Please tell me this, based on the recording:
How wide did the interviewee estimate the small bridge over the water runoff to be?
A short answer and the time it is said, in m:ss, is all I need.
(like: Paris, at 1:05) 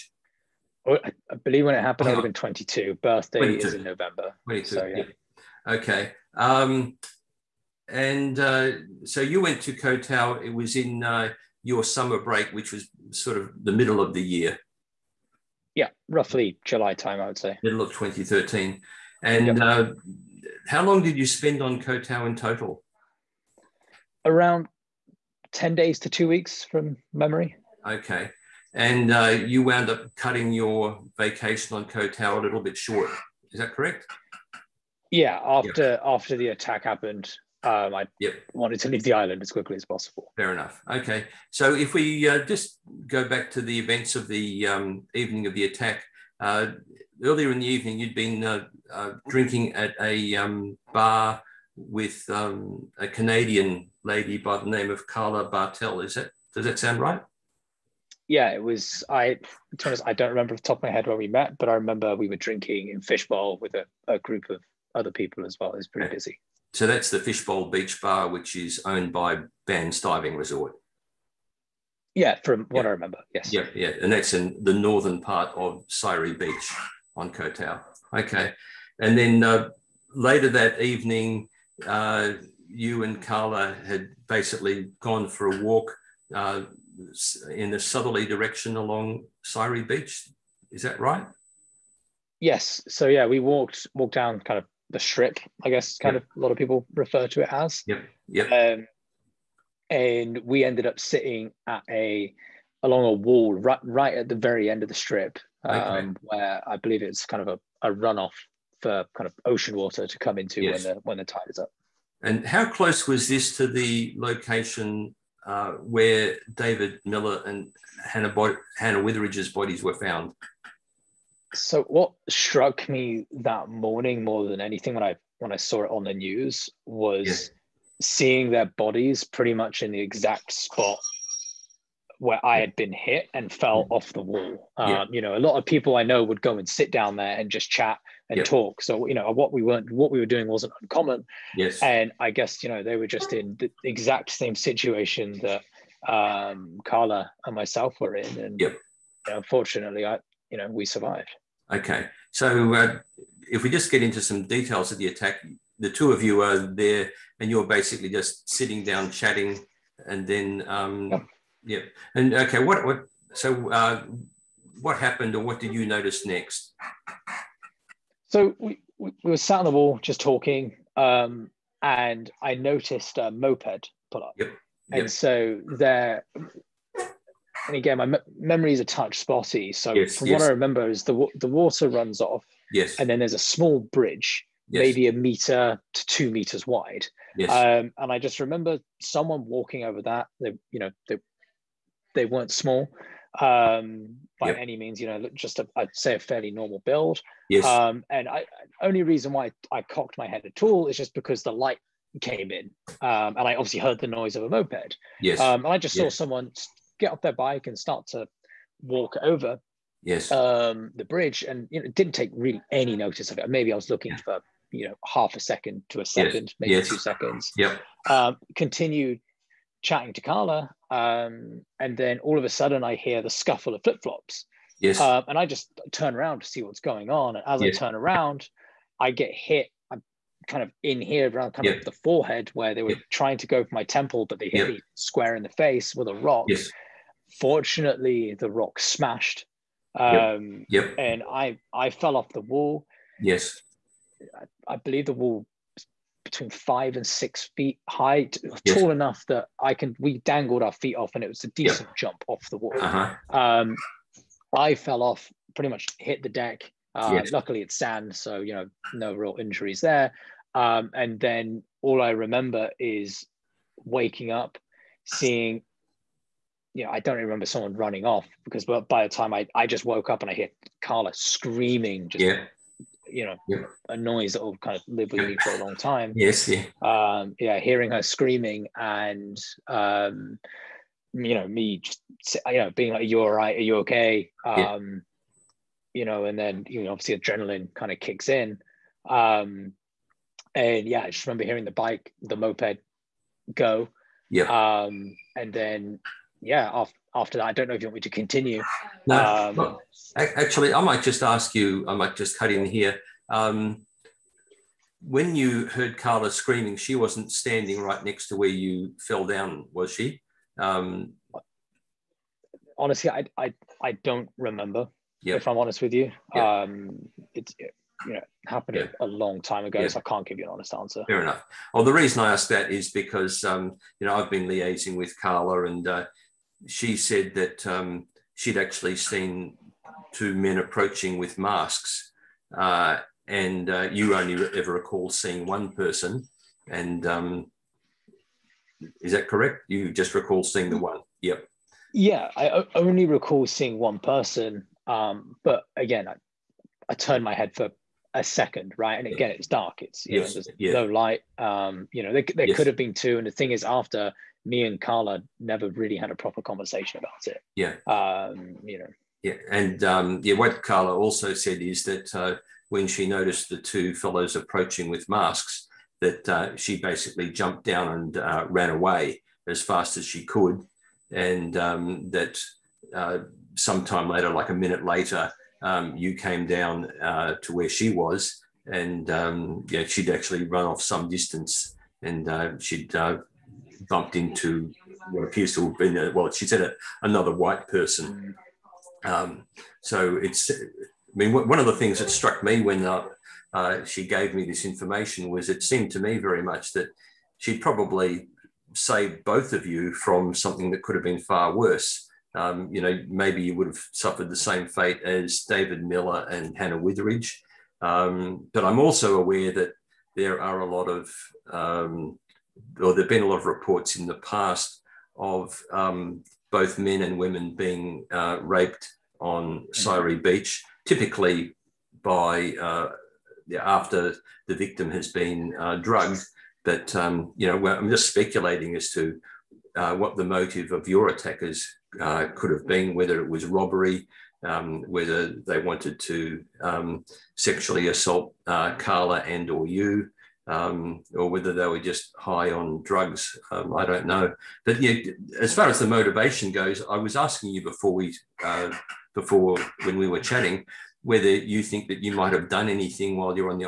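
1 to 2 meters, at 3:04.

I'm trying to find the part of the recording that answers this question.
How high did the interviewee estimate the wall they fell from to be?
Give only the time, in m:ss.
4:06.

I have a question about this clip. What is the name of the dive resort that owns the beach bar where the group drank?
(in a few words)
Ban's Diving Resort.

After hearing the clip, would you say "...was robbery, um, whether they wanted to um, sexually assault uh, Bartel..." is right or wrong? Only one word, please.
wrong.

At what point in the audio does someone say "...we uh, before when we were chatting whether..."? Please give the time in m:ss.
7:27.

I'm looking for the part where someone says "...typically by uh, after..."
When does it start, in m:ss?
7:00.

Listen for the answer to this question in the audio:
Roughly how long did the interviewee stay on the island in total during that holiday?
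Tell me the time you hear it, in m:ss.
0:24.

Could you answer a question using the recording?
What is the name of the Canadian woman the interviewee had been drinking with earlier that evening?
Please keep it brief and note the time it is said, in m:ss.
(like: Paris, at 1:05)
Carla Bartel, at 0:55.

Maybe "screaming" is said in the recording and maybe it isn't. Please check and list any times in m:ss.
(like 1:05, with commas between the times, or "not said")
4:31, 4:38, 5:06.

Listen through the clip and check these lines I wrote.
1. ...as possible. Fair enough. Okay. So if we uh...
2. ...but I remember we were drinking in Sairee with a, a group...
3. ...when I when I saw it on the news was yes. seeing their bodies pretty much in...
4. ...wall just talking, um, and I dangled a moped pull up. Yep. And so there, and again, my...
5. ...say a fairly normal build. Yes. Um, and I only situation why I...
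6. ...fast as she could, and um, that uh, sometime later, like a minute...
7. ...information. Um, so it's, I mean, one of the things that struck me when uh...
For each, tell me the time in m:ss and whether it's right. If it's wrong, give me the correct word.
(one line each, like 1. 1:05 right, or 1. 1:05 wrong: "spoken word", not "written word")
1. 0:39 right
2. 1:01 wrong: "Fishbowl", not "Sairee"
3. 2:04 right
4. 2:49 wrong: "noticed", not "dangled"
5. 3:15 wrong: "reason", not "situation"
6. 6:09 right
7. 6:27 wrong: "person", not "information".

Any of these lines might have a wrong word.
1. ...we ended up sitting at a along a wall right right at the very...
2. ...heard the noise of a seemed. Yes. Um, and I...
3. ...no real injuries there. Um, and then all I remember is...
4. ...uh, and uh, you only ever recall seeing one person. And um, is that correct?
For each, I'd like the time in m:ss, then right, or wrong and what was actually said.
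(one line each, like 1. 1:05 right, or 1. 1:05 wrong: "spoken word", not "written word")
1. 1:40 right
2. 3:23 wrong: "moped", not "seemed"
3. 4:18 right
4. 5:32 right.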